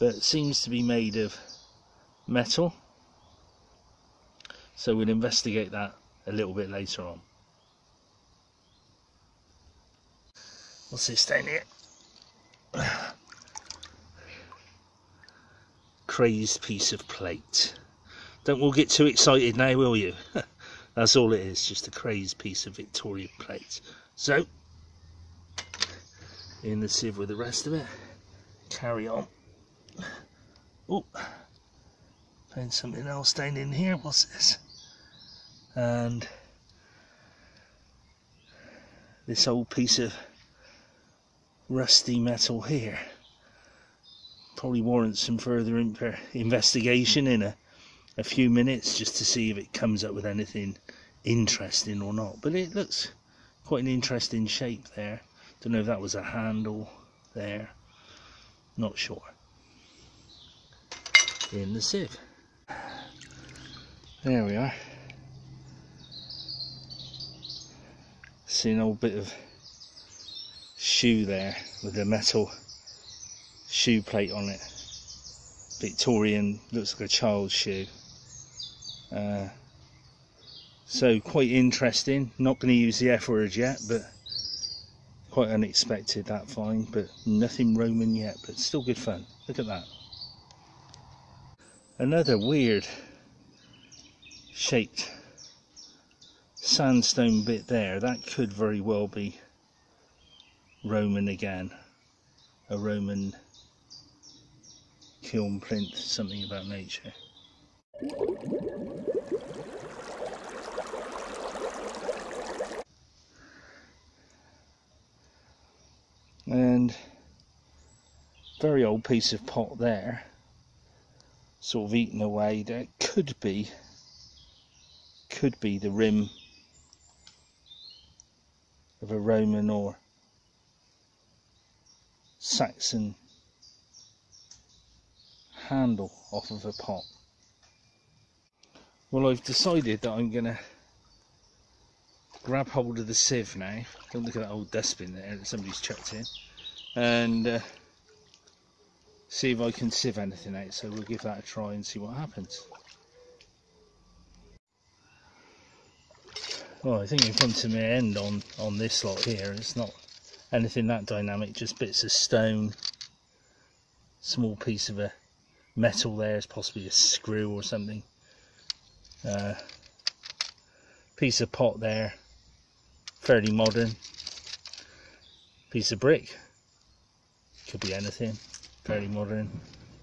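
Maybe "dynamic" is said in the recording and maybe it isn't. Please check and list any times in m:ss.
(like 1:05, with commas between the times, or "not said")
2:41.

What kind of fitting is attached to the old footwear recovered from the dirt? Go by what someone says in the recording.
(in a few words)
metal shoe plate.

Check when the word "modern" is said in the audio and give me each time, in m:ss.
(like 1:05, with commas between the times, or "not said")
2:53, 2:59.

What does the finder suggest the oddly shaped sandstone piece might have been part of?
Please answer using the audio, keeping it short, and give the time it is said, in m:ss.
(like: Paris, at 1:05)
A Roman kiln plinth, at 1:42.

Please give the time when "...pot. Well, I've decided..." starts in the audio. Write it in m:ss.
2:16.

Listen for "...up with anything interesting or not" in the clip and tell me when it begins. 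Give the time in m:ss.
0:50.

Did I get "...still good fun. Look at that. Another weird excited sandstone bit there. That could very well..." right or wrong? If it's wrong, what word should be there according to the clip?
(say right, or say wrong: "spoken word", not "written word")
wrong: "shaped", not "excited".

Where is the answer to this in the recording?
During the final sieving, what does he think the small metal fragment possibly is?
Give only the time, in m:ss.
2:46.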